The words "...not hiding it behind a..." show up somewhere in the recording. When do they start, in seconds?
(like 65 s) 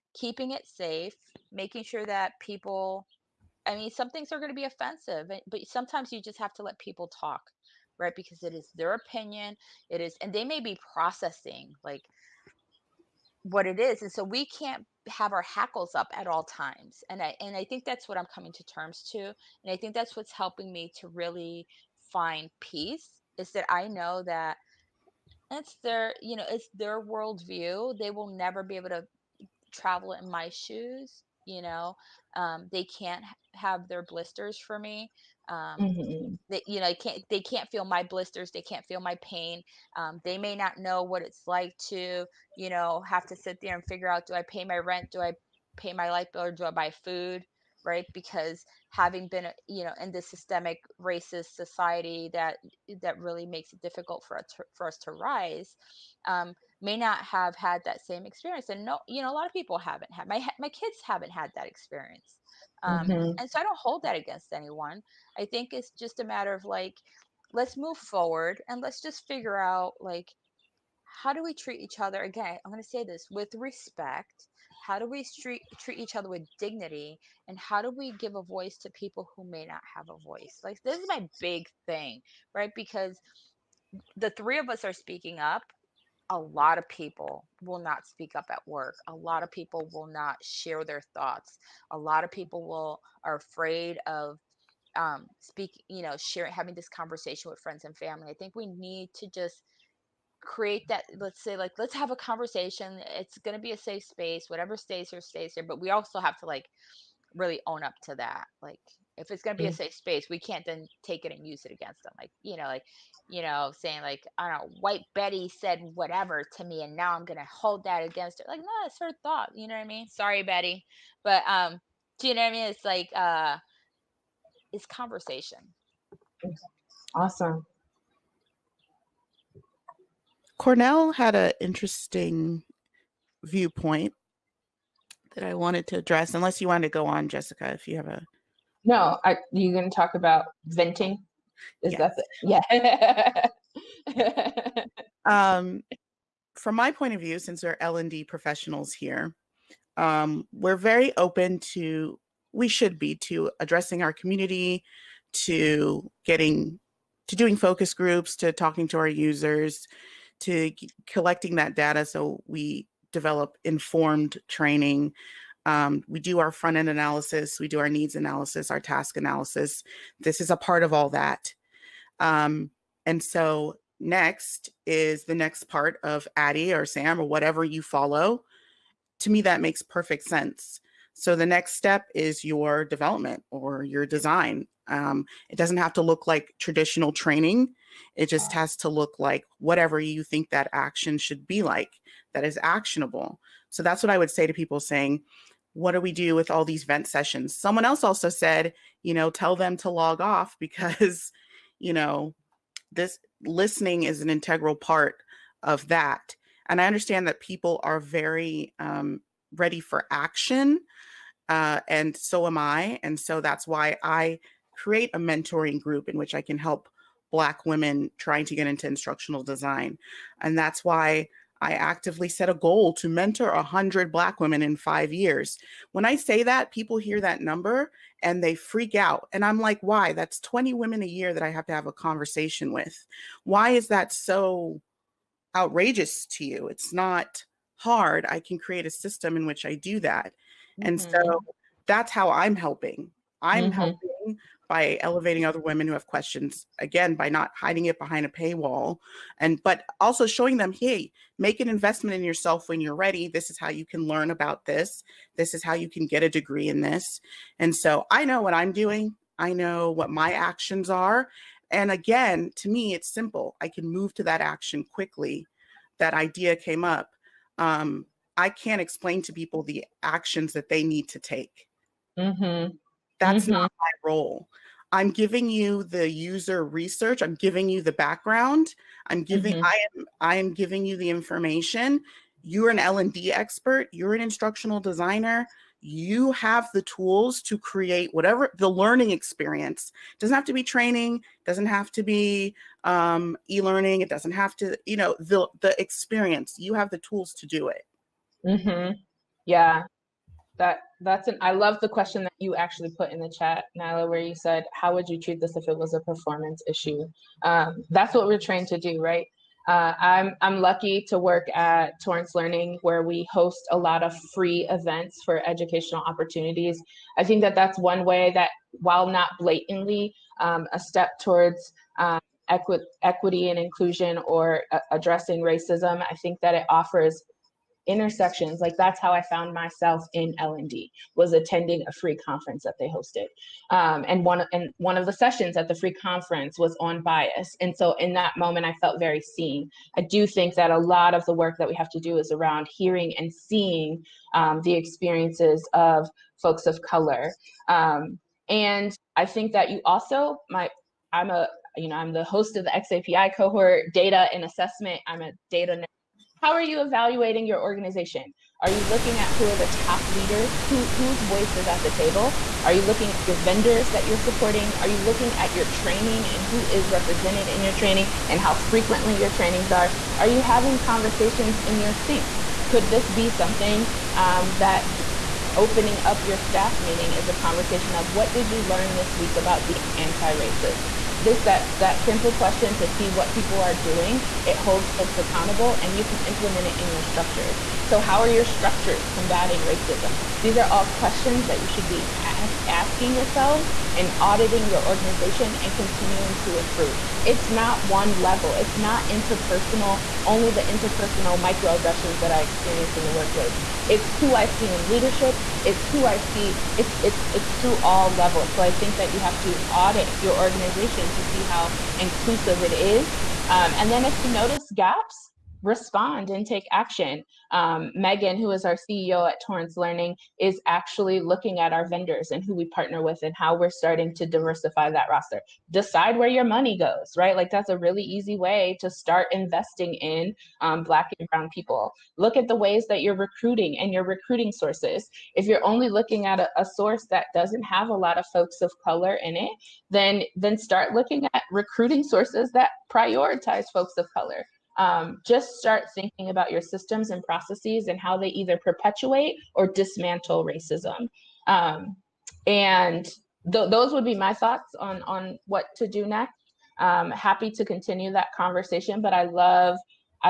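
247 s.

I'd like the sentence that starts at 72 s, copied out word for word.
Again, I'm going to say this with respect.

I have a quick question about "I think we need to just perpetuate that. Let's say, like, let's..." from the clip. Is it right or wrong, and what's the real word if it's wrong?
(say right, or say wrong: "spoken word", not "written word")
wrong: "create", not "perpetuate".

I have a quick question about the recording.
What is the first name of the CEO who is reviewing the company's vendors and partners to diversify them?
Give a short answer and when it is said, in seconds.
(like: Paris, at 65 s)
Megan, at 417 s.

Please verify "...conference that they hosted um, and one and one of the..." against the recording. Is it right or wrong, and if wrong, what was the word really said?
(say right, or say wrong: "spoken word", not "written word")
right.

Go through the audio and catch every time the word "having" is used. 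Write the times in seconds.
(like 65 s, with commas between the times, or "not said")
48 s, 96 s, 370 s.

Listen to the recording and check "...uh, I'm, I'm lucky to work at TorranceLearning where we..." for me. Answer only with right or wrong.
right.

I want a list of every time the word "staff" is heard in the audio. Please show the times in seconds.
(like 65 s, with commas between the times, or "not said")
376 s.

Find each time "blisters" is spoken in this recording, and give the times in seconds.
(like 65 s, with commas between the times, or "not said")
34 s, 38 s.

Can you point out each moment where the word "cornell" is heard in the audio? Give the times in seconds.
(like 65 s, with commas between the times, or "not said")
130 s.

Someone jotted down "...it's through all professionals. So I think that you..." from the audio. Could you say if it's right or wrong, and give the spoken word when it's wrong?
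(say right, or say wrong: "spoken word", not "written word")
wrong: "levels", not "professionals".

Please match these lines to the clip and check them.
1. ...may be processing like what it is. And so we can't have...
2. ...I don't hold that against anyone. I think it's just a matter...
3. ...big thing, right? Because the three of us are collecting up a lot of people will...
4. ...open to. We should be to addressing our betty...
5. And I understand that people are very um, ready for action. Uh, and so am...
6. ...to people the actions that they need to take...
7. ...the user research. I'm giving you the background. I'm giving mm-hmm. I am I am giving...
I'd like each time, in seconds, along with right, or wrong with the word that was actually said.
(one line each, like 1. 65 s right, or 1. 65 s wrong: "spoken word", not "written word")
1. 10 s right
2. 63 s right
3. 81 s wrong: "speaking", not "collecting"
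4. 151 s wrong: "community", not "betty"
5. 206 s right
6. 269 s right
7. 275 s right.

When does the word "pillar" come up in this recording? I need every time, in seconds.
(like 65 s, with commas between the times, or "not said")
not said.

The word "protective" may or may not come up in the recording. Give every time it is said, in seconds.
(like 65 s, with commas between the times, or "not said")
not said.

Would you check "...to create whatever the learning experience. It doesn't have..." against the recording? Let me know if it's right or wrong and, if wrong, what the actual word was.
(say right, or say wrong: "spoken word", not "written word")
right.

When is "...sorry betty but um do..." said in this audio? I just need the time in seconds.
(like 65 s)
120 s.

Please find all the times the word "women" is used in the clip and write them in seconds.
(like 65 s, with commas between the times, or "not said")
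217 s, 224 s, 230 s, 245 s.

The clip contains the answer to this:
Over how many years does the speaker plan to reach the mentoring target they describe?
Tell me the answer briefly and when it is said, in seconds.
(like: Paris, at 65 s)
5 years, at 224 s.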